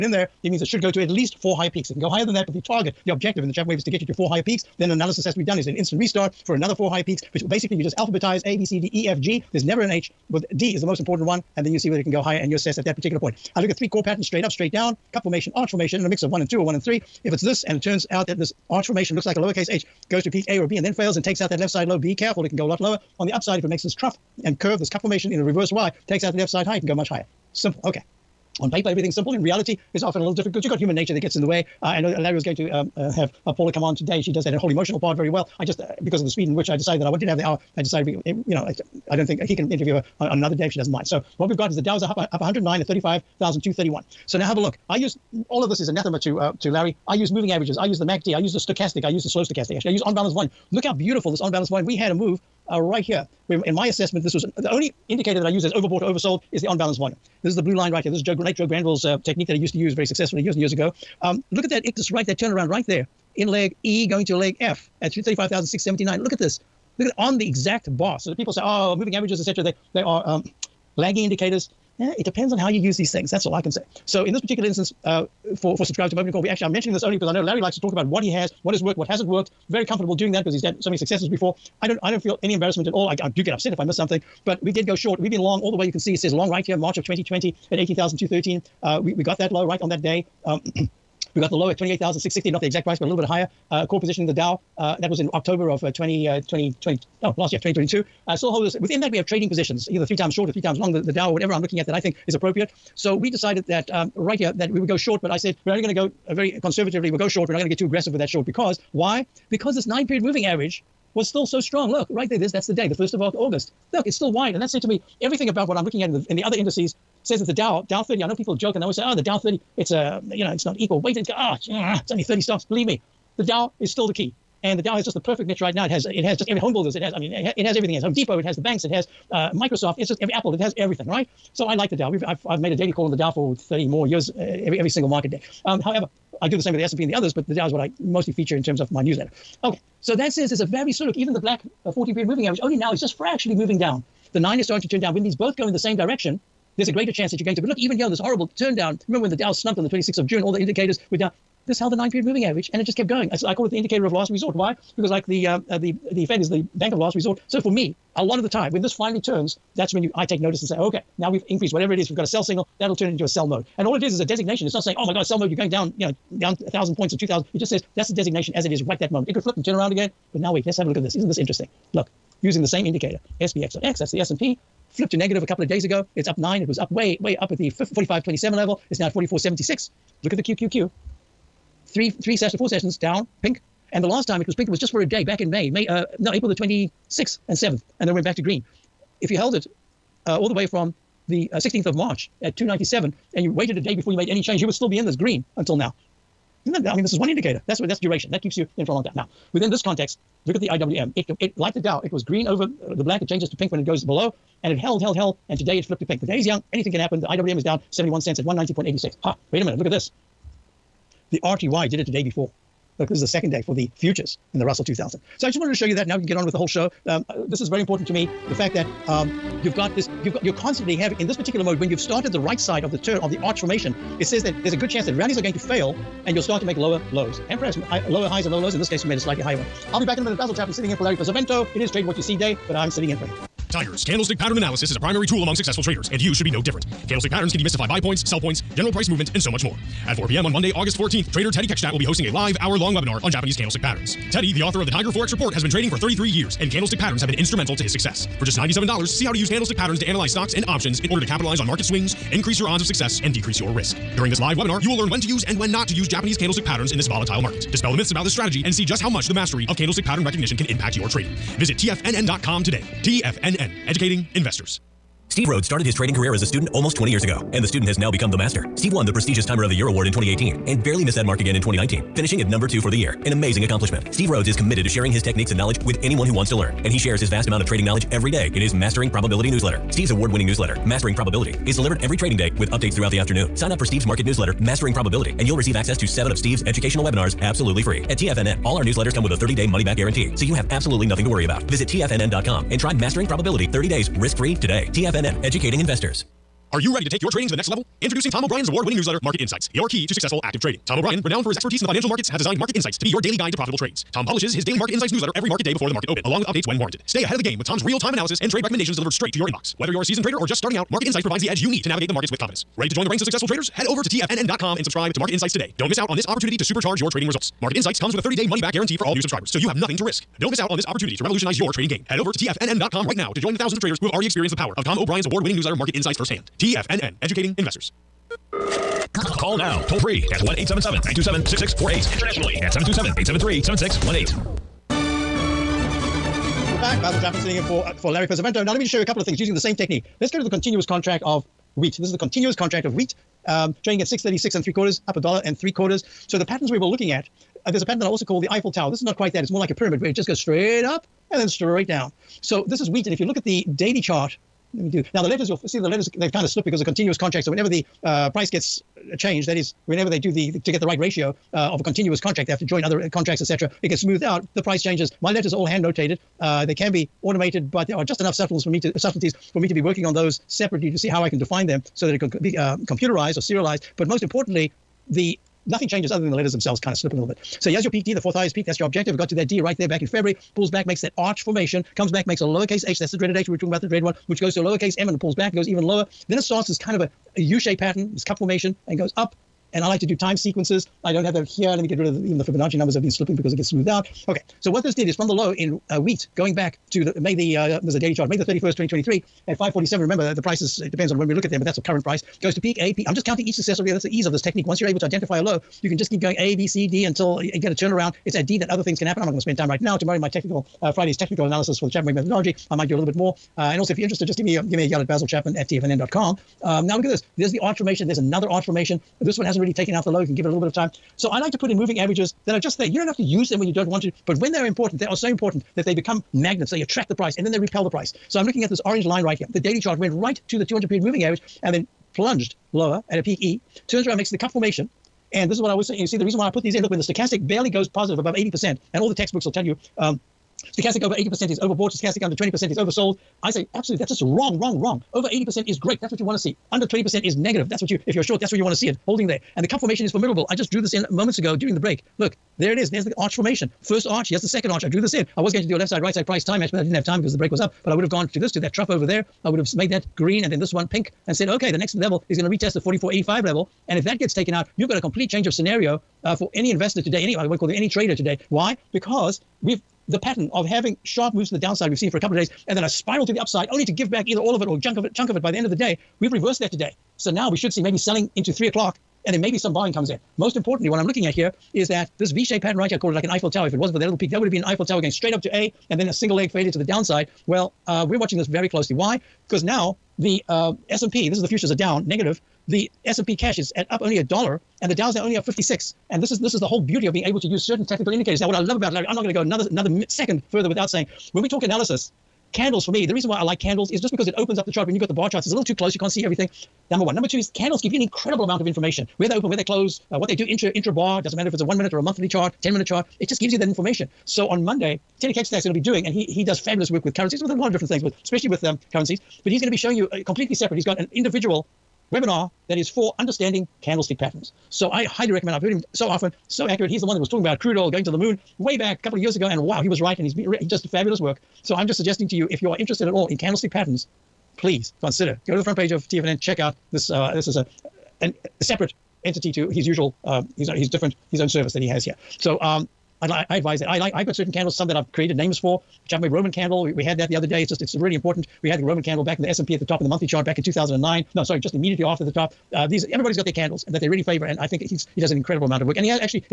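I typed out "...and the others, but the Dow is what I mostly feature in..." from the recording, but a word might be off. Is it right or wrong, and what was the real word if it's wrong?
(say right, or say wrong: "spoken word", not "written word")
right.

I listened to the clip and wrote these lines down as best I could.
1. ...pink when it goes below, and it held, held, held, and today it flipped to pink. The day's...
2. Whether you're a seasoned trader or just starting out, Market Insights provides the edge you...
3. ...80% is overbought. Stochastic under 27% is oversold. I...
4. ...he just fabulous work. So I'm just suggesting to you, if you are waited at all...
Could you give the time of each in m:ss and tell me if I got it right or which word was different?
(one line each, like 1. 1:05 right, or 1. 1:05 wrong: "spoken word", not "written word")
1. 3:23 right
2. 5:09 right
3. 7:21 wrong: "20", not "27"
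4. 8:50 wrong: "interested", not "waited".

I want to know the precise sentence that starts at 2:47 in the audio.
It just says that's the designation as it is right that moment.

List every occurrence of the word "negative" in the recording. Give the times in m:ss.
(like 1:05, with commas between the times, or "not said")
2:55, 7:27, 8:12.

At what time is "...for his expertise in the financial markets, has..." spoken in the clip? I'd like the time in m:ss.
5:01.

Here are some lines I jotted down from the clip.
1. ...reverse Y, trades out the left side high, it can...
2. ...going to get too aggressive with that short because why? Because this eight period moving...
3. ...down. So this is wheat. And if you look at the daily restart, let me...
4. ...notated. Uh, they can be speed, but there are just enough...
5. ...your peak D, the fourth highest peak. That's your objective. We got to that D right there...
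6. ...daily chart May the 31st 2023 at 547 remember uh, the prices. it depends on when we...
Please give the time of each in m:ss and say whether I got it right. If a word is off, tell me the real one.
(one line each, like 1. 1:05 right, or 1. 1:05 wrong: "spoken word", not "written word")
1. 0:25 wrong: "takes", not "trades"
2. 1:47 wrong: "nine", not "eight"
3. 5:51 wrong: "chart", not "restart"
4. 6:05 wrong: "automated", not "speed"
5. 6:17 right
6. 6:37 right.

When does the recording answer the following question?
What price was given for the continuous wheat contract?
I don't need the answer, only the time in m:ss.
5:44.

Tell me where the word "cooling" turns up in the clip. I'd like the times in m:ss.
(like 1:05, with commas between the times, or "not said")
not said.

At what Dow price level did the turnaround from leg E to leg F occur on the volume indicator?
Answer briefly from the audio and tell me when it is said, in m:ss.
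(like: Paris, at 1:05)
35,679, at 1:05.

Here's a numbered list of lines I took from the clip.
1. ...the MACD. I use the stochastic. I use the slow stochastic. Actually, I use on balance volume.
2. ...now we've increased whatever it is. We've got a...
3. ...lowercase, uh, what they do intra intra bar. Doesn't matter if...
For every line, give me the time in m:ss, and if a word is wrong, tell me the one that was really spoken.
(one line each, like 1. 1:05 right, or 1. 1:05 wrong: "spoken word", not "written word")
1. 0:47 right
2. 2:41 right
3. 8:29 wrong: "close", not "lowercase".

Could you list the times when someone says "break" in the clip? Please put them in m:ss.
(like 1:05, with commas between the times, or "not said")
7:31, 7:37.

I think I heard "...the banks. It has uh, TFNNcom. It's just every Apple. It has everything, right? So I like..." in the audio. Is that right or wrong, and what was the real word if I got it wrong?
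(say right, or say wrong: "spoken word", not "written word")
wrong: "Microsoft", not "TFNNcom".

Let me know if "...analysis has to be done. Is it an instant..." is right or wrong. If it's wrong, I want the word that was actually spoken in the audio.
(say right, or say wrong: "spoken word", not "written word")
right.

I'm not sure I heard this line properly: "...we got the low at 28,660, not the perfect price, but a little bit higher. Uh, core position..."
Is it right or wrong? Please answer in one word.
wrong.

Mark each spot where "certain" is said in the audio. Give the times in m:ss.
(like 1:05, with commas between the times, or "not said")
8:17, 9:04.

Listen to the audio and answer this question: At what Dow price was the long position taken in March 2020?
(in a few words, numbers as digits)
18,213.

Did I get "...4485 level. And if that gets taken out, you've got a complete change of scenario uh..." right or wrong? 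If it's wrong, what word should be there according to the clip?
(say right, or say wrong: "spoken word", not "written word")
right.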